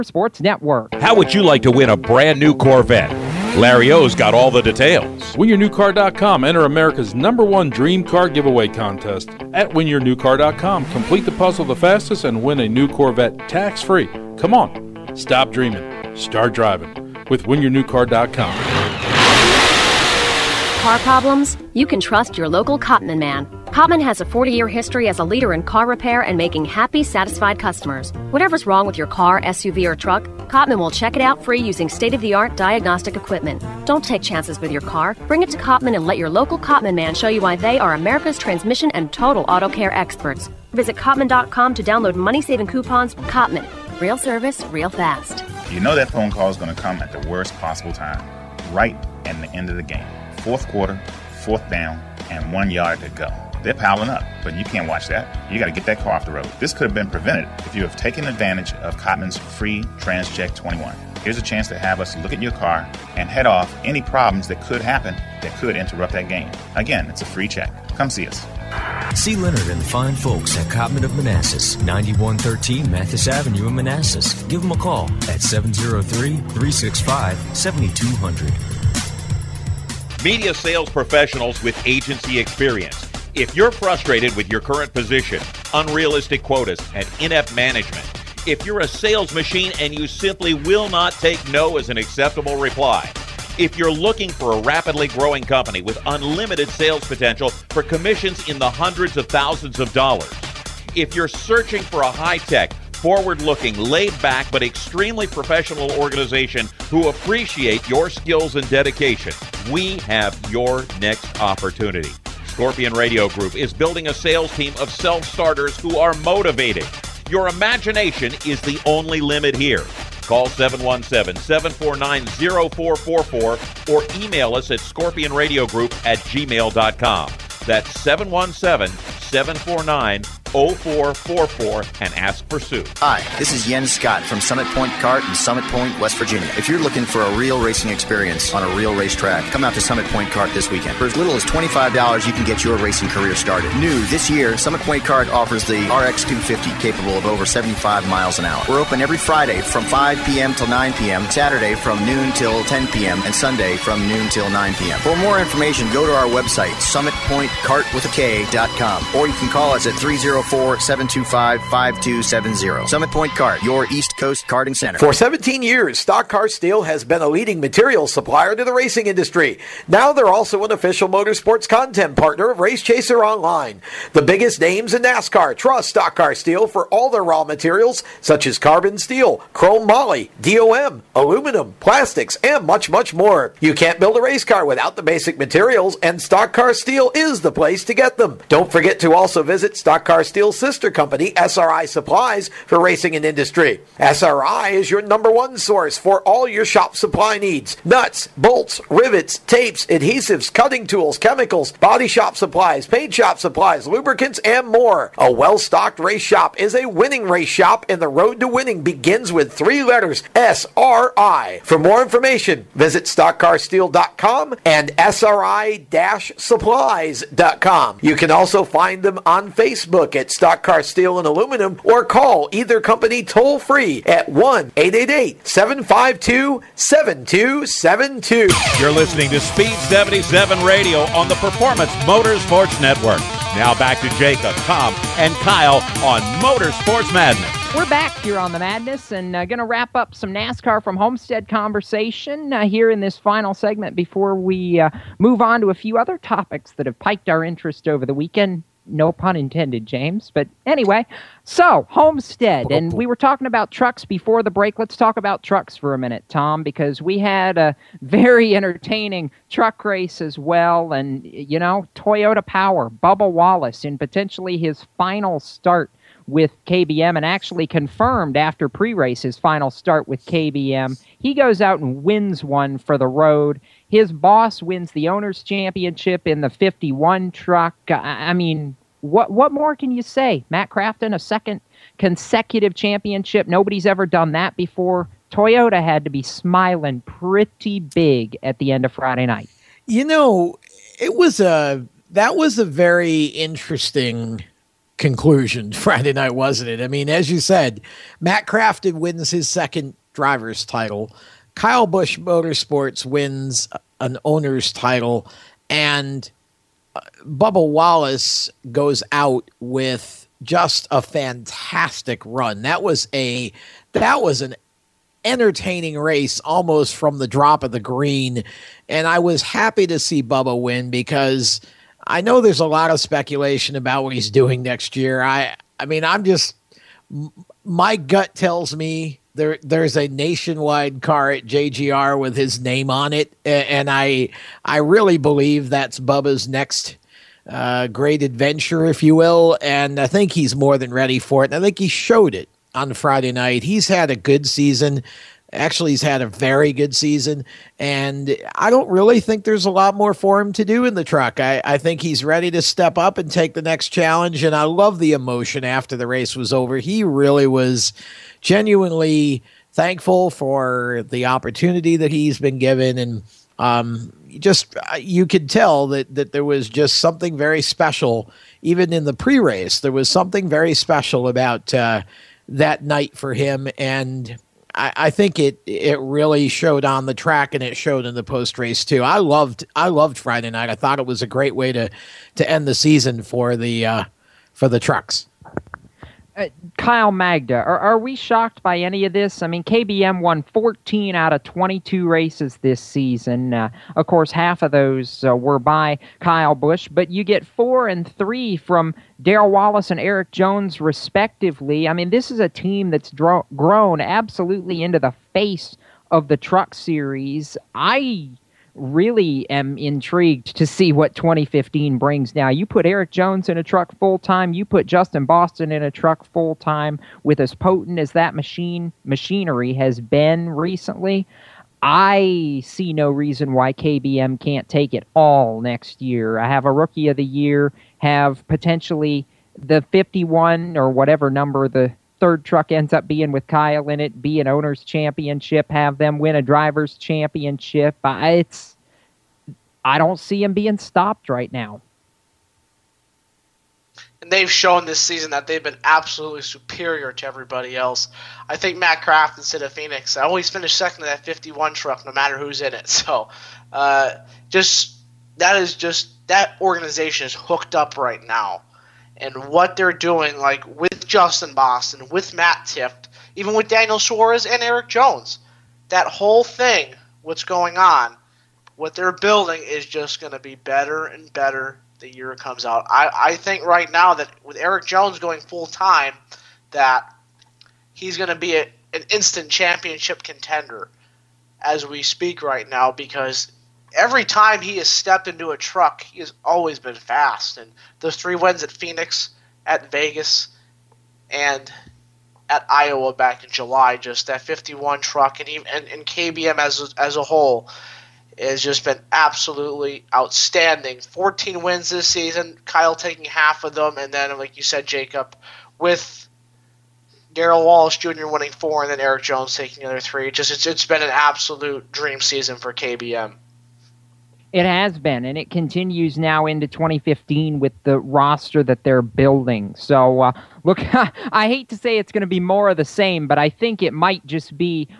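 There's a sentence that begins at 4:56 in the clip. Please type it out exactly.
I mean, as you said, Matt Crafton wins his second driver's title.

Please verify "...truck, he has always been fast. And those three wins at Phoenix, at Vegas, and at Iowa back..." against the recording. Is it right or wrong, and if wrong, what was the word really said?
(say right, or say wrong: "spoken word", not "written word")
right.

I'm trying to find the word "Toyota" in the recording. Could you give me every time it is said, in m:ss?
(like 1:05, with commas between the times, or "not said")
4:21, 4:45.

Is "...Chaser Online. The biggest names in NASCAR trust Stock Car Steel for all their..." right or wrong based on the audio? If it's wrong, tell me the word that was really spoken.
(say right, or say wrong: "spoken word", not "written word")
right.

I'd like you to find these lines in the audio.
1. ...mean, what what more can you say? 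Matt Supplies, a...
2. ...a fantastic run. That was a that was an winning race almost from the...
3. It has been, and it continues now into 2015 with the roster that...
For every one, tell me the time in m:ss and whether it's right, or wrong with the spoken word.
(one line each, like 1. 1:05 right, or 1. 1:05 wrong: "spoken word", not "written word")
1. 4:38 wrong: "Crafton", not "Supplies"
2. 5:10 wrong: "entertaining", not "winning"
3. 8:34 right.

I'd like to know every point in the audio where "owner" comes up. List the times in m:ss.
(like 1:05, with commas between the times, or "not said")
4:35, 5:04, 7:14.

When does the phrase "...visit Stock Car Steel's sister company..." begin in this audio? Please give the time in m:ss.
3:09.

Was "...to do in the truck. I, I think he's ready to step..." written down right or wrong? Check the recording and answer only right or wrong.
right.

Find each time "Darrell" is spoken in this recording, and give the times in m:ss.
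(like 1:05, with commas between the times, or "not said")
6:39, 8:27.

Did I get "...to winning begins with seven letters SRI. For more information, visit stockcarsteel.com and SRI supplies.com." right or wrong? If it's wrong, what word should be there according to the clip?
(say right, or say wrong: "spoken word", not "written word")
wrong: "three", not "seven".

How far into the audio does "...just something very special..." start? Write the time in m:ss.
6:06.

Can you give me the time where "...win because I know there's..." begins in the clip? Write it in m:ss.
5:20.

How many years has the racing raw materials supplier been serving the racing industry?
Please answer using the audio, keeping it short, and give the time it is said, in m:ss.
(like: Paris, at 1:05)
17, at 2:45.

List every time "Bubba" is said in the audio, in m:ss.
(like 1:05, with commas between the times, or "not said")
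4:22, 5:07, 5:20, 5:35.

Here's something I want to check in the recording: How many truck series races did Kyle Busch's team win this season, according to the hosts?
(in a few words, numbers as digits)
14.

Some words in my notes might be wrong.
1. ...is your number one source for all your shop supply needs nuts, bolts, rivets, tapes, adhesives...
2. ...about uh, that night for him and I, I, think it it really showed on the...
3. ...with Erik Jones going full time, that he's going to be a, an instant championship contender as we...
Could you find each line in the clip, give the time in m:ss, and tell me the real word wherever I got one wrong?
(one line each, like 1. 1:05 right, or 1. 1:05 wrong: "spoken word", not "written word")
1. 3:14 right
2. 6:11 right
3. 7:54 right.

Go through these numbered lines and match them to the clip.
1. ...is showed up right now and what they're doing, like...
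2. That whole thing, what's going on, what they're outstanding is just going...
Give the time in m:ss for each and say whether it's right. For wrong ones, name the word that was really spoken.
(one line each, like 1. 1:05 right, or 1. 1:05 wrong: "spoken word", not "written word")
1. 7:37 wrong: "hooked", not "showed"
2. 7:45 wrong: "building", not "outstanding".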